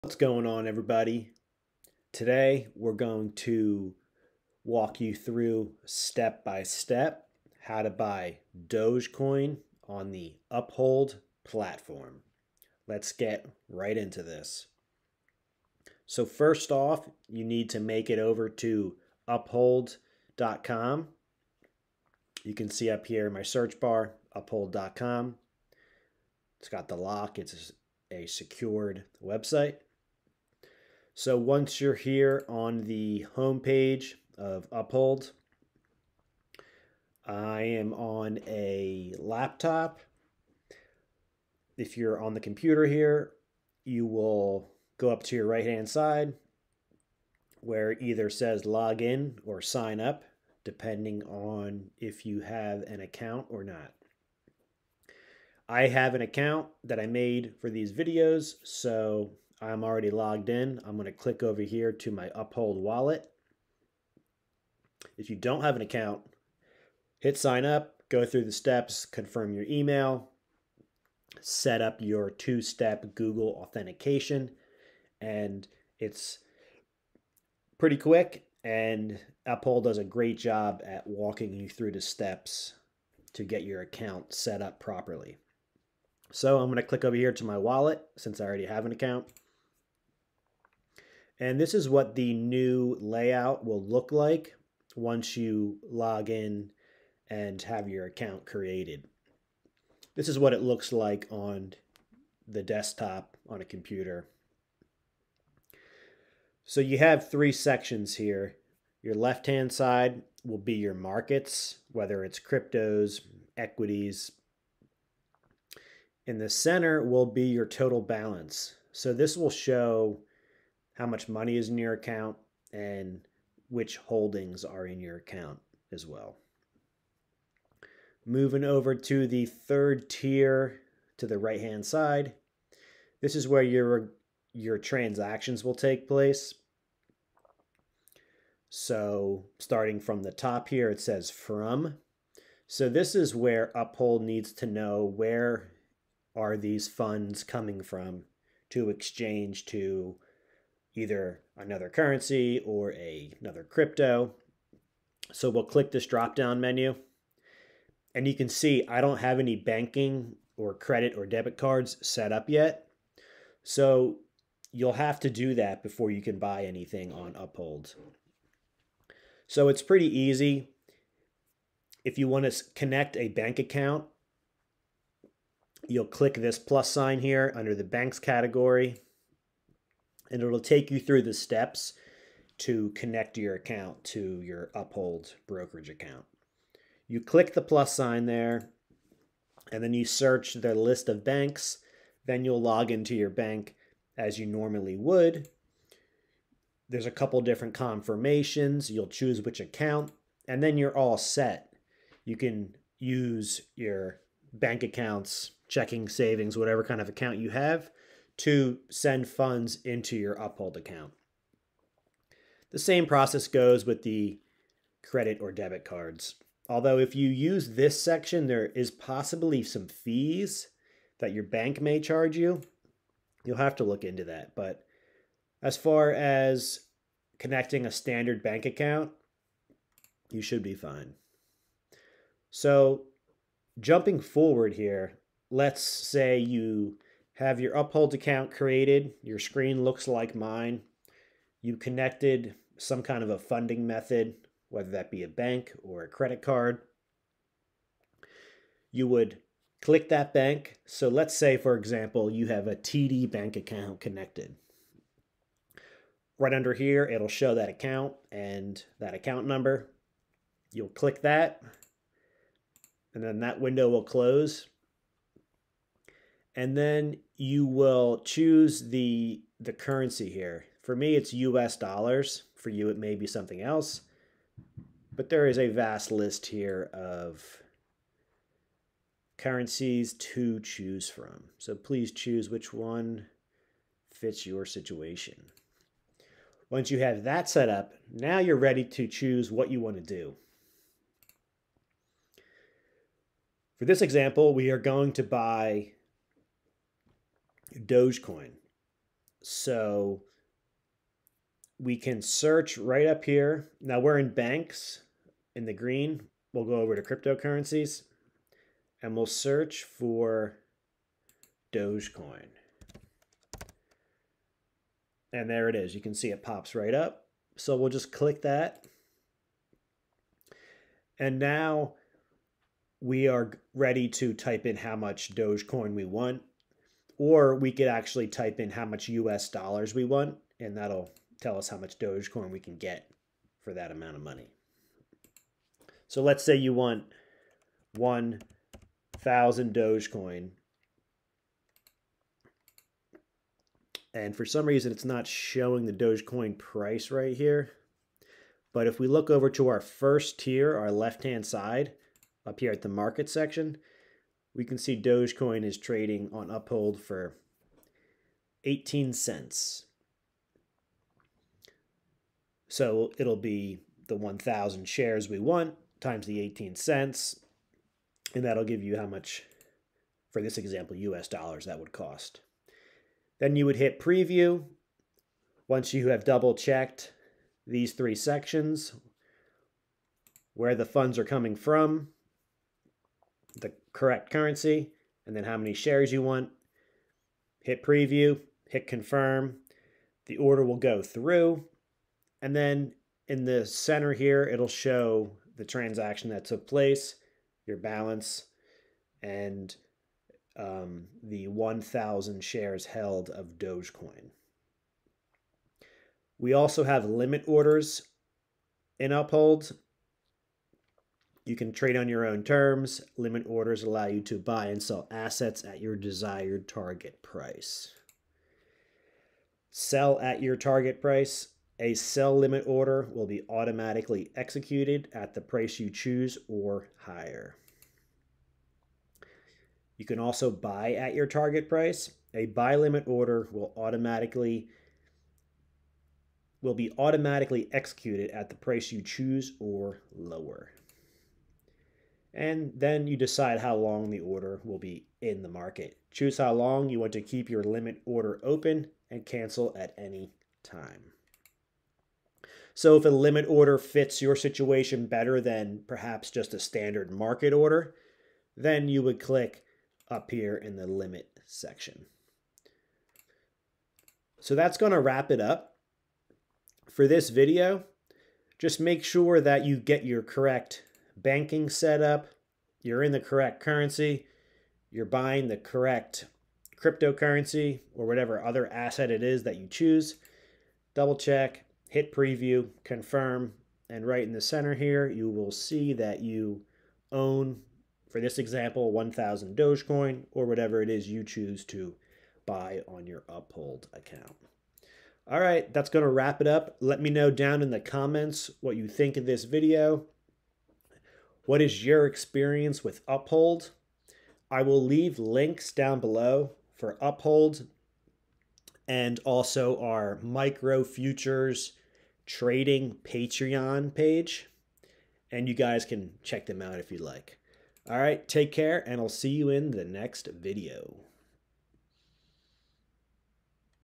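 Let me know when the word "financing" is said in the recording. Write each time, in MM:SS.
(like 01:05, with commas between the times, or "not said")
not said.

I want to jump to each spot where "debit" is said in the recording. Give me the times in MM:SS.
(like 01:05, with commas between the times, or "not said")
02:41, 03:35.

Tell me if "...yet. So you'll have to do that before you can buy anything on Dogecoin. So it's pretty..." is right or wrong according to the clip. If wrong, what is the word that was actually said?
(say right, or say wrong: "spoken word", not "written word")
wrong: "Uphold", not "Dogecoin".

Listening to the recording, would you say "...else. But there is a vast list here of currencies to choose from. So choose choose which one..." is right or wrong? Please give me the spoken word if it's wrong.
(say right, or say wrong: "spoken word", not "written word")
wrong: "please", not "choose".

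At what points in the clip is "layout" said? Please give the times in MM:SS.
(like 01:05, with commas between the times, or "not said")
01:32.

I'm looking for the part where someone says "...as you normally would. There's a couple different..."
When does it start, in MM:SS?
03:14.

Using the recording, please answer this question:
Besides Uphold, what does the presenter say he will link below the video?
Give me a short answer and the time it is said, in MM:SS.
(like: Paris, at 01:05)
micro futures trading, at 08:30.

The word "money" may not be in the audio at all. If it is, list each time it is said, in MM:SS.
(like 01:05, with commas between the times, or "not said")
02:01, 05:34.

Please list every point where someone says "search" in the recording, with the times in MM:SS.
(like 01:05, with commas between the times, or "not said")
00:23, 03:10, 05:02, 05:09.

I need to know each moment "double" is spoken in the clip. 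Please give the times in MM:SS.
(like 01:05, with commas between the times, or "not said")
06:16, 08:00.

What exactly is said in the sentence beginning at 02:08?
Moving over to the third tier to the right hand side, this is where your, your transactions will take place.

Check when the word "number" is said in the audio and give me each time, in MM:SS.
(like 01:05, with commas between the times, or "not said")
04:19.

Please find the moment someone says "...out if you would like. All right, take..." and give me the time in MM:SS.
08:36.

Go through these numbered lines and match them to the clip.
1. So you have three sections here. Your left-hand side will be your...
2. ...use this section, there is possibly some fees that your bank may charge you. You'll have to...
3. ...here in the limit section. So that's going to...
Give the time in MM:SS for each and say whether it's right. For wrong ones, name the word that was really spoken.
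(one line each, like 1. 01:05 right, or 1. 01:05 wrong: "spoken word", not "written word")
1. 01:46 right
2. 03:37 right
3. 07:40 right.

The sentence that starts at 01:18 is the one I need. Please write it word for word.
And Uphold does a great job at walking you through the steps to get your account set up properly.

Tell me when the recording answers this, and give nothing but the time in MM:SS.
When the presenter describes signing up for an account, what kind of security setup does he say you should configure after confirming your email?
01:12.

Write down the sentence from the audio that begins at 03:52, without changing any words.
So jumping forward here, let's say you have your uphold account created.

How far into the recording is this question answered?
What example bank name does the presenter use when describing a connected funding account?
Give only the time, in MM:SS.
04:12.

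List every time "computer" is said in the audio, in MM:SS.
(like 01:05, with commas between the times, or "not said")
00:42, 01:43.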